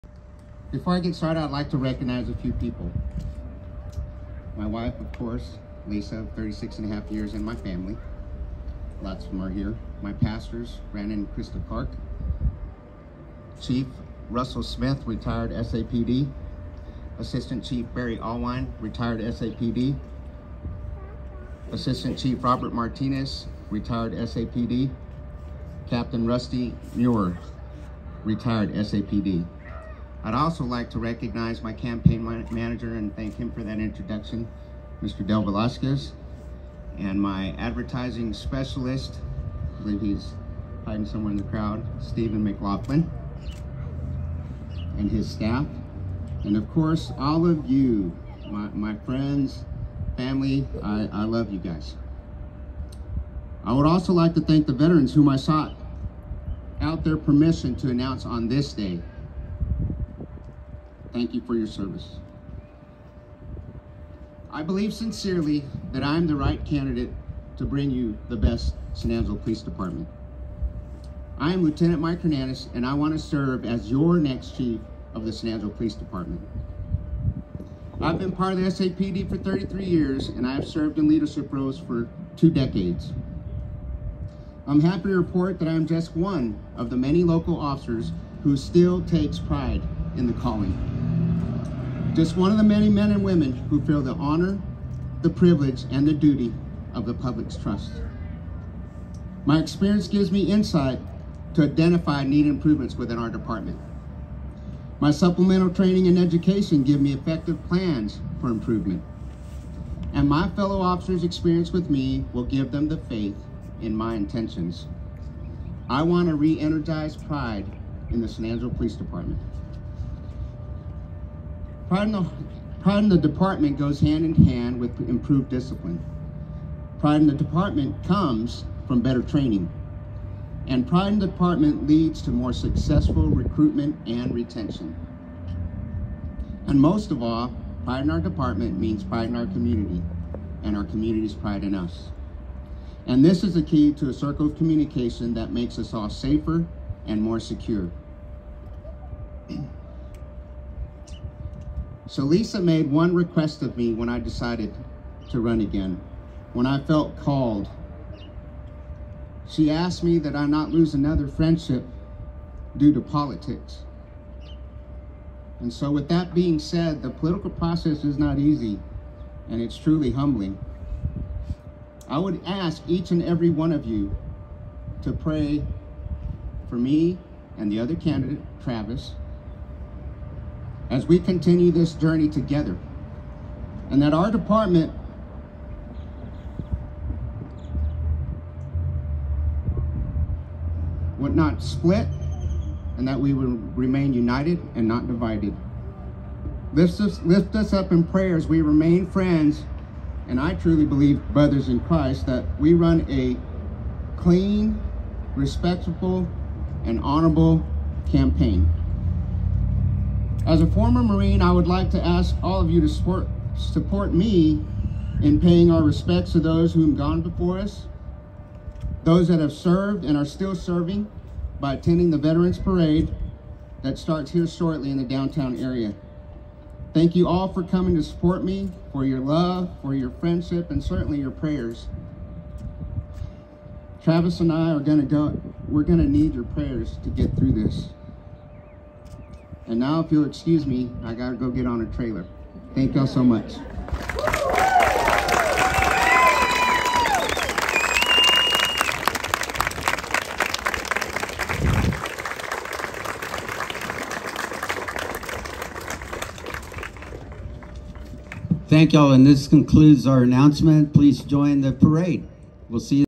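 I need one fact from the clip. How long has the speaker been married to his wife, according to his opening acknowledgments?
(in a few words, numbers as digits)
36 and a half years.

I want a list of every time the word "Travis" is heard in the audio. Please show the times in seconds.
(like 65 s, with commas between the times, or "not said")
178 s, 234 s.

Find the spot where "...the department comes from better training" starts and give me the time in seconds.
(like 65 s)
127 s.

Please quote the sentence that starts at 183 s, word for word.
And that our department would not split and that we would remain united and not divided.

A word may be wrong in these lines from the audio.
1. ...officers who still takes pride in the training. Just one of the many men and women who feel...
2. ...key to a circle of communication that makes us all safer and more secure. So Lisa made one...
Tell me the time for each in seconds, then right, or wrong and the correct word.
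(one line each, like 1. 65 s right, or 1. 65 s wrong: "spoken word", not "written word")
1. 87 s wrong: "calling", not "training"
2. 143 s right.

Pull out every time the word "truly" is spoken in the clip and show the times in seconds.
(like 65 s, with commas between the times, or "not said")
169 s, 200 s.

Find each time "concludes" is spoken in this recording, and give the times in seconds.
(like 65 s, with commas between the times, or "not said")
259 s.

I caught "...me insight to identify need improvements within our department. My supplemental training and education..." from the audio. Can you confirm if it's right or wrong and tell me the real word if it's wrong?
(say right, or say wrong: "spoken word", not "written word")
right.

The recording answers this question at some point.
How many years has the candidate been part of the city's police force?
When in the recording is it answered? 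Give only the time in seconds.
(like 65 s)
79 s.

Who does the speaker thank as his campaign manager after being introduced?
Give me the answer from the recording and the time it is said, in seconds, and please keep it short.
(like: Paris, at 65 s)
Del Velasquez, at 35 s.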